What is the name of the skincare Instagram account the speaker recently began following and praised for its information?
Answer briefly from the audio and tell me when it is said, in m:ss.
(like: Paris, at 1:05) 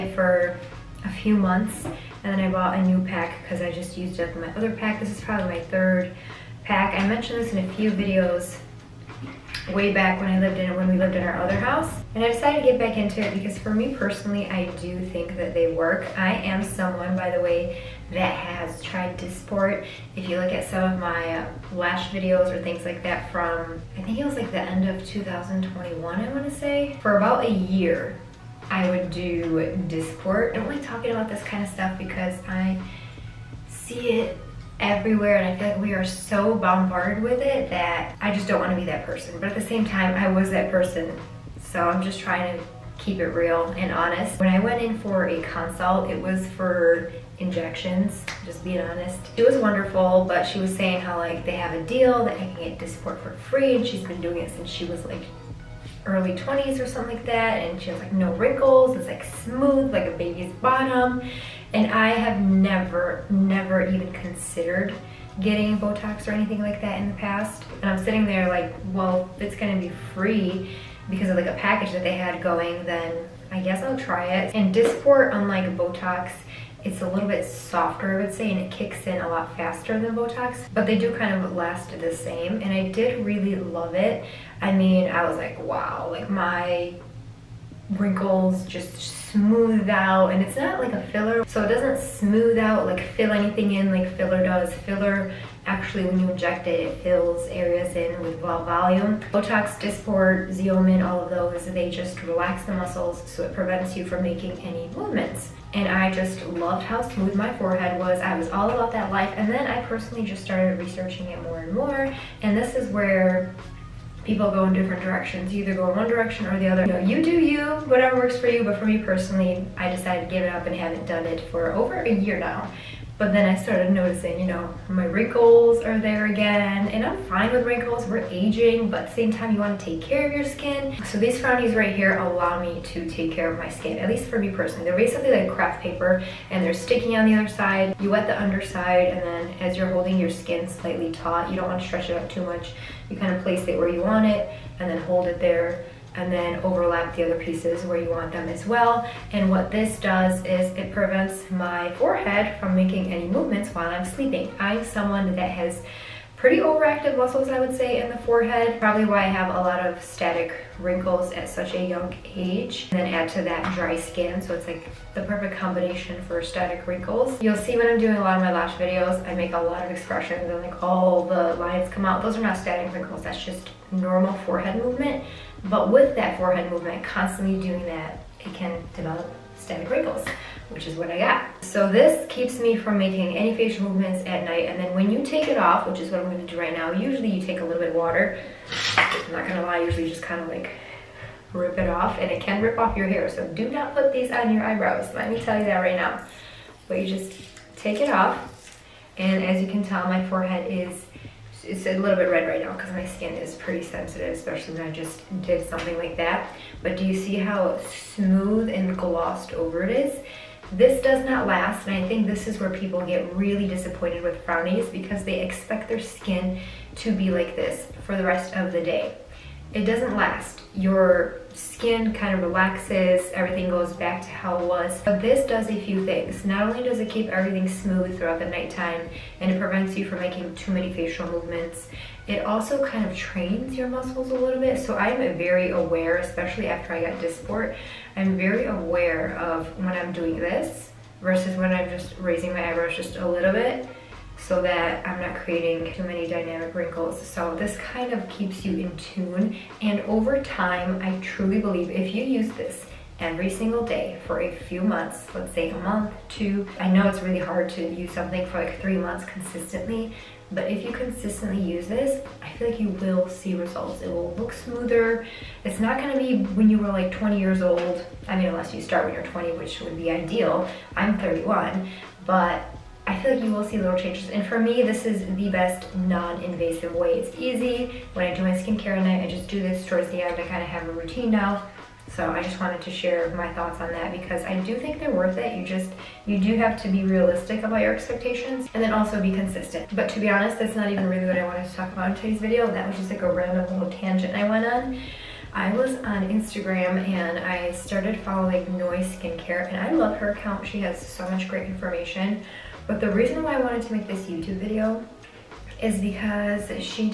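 Noy Skincare, at 4:58.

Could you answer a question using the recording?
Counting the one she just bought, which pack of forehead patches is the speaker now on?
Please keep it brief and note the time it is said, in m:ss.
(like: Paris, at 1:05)
third, at 0:05.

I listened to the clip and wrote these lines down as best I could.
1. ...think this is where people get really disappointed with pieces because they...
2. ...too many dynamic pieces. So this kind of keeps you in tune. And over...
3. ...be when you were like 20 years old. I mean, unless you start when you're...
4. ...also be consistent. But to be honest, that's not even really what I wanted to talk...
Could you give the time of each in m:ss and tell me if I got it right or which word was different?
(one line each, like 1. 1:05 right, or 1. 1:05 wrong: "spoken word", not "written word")
1. 3:32 wrong: "frownies", not "pieces"
2. 4:05 wrong: "wrinkles", not "pieces"
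3. 4:26 right
4. 4:48 right.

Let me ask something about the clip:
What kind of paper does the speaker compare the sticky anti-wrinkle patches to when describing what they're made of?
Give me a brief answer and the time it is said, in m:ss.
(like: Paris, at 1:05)
craft paper, at 2:15.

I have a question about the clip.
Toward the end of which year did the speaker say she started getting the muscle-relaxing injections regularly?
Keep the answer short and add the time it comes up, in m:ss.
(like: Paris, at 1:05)
2021, at 0:25.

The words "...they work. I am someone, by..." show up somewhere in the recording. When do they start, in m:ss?
0:15.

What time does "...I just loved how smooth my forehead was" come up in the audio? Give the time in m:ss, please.
1:45.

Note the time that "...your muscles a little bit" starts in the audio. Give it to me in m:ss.
3:53.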